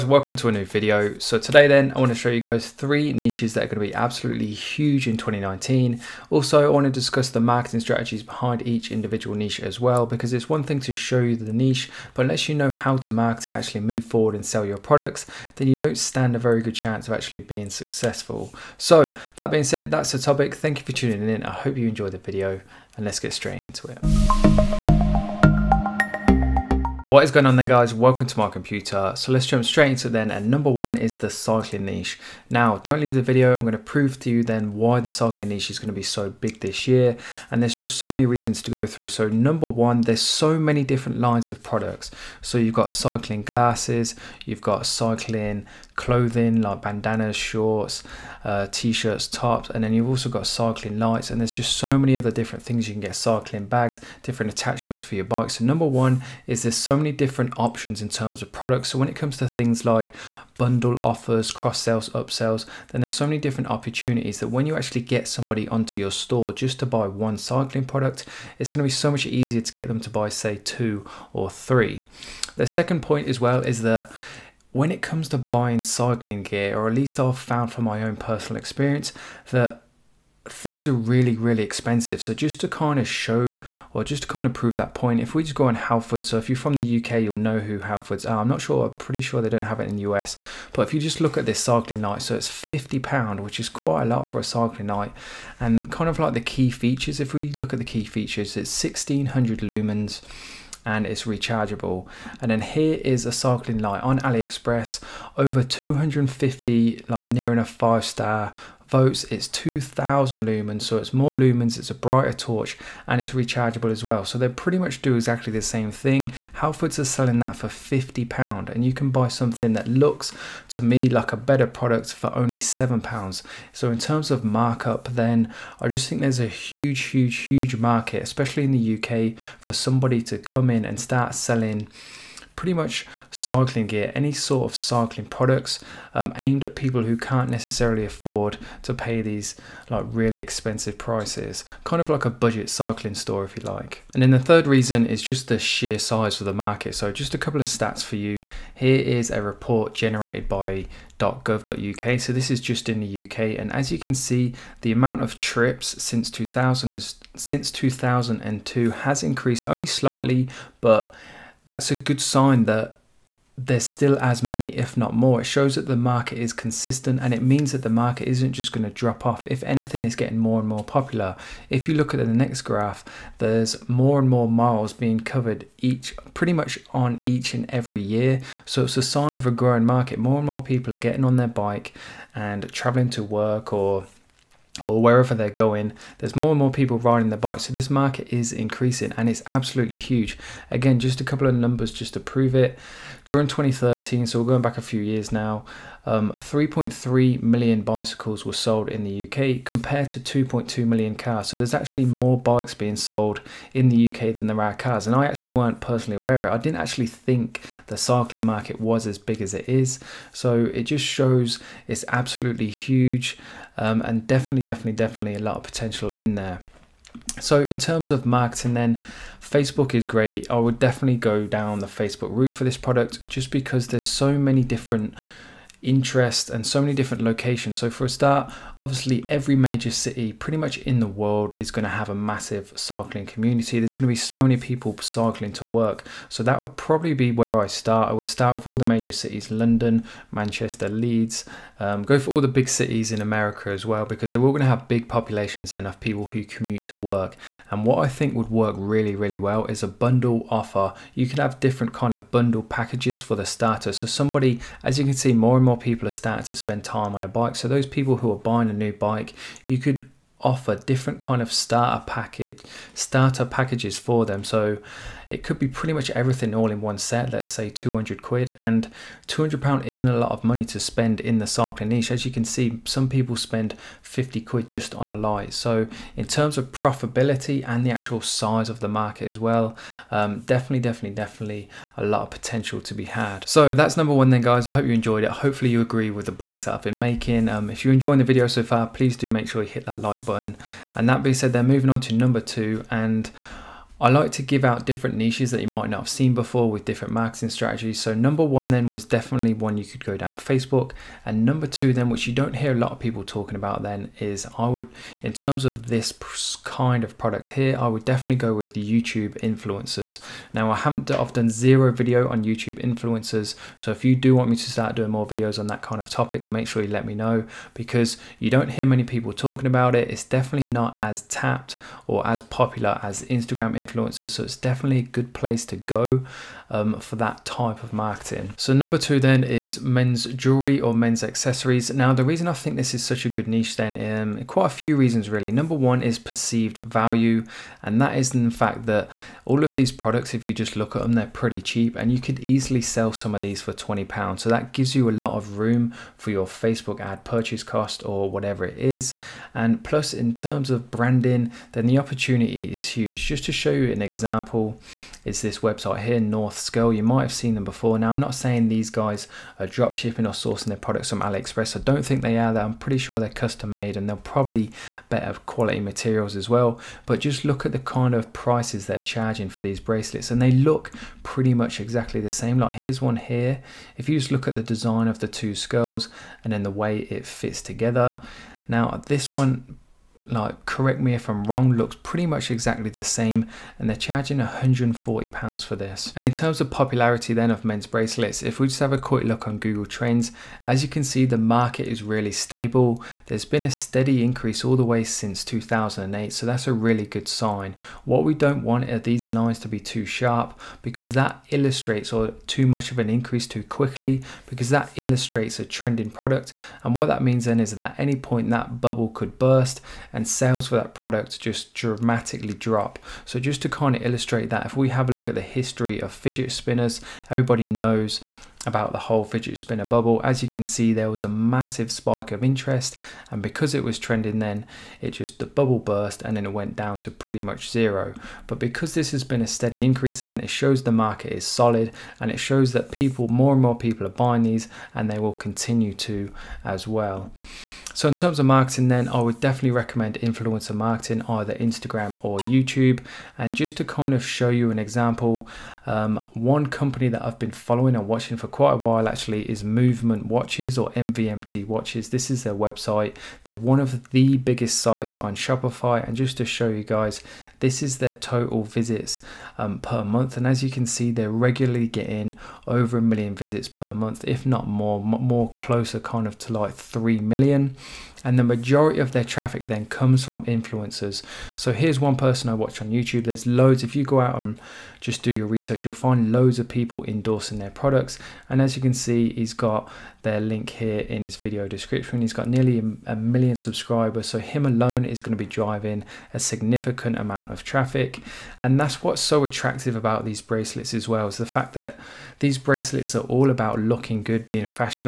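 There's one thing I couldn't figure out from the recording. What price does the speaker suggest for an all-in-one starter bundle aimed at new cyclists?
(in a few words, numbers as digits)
200 pounds.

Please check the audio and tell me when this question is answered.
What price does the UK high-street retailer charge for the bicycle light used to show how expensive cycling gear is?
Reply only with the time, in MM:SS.
01:32.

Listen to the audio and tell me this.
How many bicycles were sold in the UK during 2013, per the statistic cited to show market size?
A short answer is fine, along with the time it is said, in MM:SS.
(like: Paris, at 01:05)
3.3 million, at 03:16.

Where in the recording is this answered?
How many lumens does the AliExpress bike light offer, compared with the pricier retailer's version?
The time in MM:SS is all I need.
01:49.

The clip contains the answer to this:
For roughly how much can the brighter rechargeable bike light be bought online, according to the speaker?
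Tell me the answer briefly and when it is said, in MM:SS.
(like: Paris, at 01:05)
£7, at 02:02.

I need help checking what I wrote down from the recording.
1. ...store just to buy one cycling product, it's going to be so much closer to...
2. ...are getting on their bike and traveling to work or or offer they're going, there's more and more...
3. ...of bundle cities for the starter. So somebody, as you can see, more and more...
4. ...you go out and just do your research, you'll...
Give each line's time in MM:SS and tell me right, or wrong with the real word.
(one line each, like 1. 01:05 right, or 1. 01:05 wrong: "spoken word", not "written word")
1. 01:06 wrong: "easier", not "closer"
2. 03:00 wrong: "wherever", not "offer"
3. 04:12 wrong: "packages", not "cities"
4. 07:53 right.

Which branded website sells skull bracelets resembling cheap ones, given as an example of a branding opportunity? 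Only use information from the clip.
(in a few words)
Northskull.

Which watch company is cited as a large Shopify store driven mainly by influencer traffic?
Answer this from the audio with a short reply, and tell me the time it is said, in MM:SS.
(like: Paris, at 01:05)
MVMT Watches, at 07:30.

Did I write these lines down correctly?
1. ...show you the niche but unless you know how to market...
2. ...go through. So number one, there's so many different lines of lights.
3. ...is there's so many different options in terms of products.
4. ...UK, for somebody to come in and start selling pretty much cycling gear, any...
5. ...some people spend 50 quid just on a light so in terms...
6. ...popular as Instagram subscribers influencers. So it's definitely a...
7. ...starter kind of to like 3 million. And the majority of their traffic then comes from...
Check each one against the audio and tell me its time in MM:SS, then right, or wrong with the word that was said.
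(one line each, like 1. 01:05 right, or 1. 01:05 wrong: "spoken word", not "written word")
1. 00:10 right
2. 00:38 wrong: "products", not "lights"
3. 00:56 right
4. 02:08 right
5. 04:32 right
6. 05:22 wrong: "influencers", not "subscribers"
7. 07:45 wrong: "closer", not "starter".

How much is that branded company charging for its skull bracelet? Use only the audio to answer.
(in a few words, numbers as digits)
£140.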